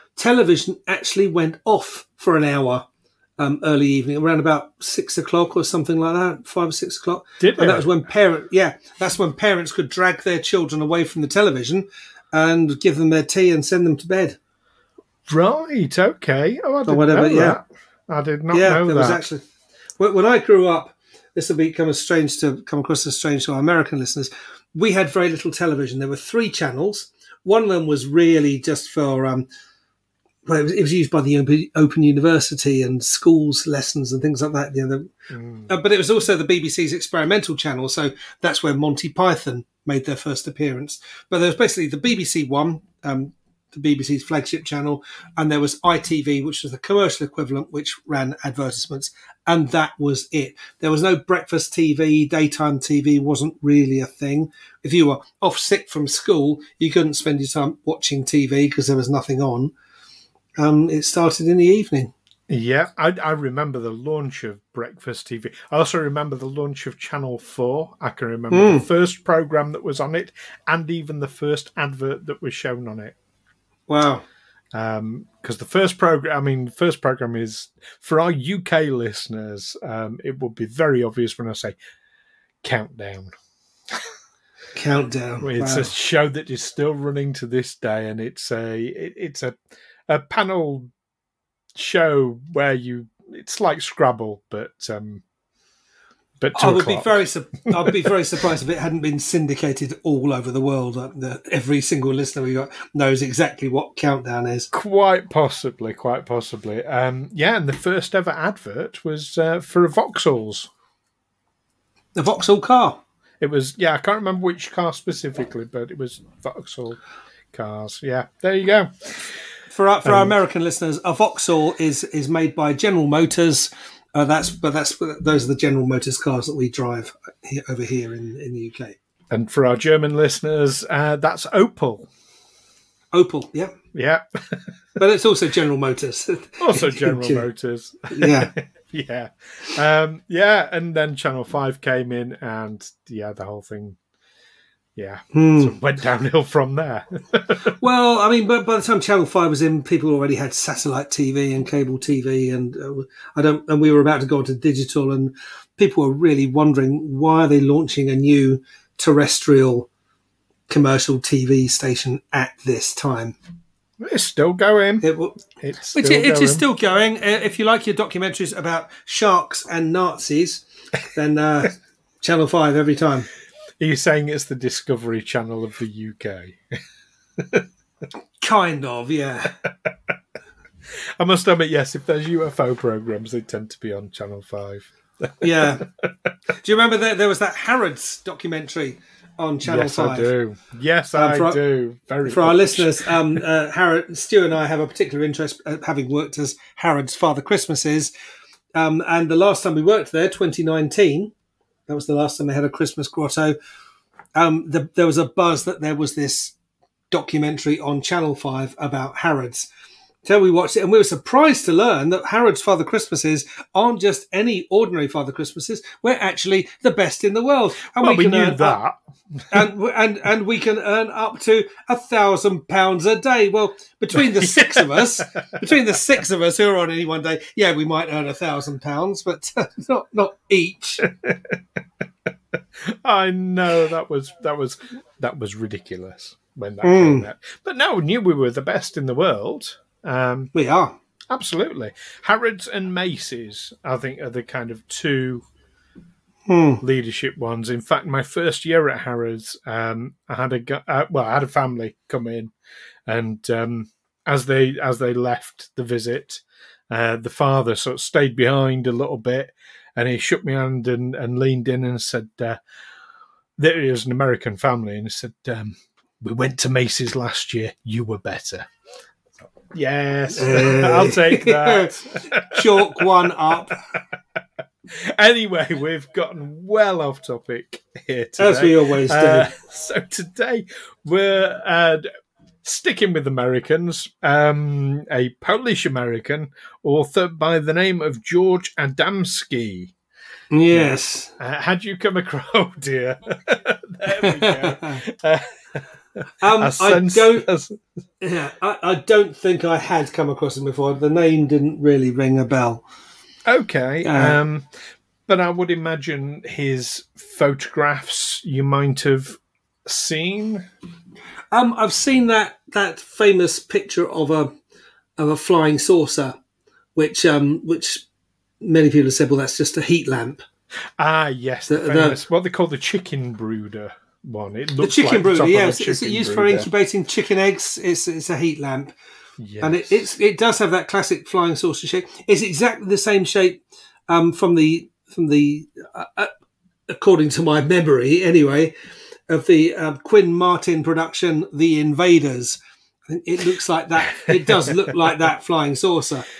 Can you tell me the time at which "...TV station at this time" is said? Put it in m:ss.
2:41.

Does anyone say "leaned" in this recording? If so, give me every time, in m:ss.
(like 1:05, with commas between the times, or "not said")
4:21.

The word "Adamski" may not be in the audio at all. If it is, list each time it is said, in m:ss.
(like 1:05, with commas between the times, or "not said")
4:48.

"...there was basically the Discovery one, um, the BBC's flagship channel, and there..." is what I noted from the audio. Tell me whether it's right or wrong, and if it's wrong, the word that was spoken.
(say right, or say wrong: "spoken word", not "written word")
wrong: "BBC", not "Discovery".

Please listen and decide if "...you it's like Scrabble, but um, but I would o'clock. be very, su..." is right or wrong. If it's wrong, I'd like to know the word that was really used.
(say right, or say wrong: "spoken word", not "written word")
right.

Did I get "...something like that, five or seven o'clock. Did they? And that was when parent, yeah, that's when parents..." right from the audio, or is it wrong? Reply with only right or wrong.
wrong.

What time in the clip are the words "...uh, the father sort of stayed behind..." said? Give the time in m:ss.
4:16.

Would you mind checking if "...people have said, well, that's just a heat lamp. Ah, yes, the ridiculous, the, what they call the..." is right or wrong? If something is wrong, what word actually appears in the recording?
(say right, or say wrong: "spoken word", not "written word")
wrong: "famous", not "ridiculous".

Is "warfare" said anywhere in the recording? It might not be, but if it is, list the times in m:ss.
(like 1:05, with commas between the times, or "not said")
not said.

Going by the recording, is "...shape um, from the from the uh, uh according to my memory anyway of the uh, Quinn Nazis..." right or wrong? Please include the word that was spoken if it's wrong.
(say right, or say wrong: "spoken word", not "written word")
wrong: "Martin", not "Nazis".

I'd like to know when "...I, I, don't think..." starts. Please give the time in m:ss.
4:58.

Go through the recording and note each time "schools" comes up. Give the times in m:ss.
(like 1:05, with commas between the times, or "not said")
0:33, 0:56.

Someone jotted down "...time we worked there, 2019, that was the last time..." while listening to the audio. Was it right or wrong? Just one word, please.
right.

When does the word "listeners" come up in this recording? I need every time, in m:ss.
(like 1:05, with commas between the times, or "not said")
0:23, 1:18, 1:42, 2:00, 2:10, 3:12.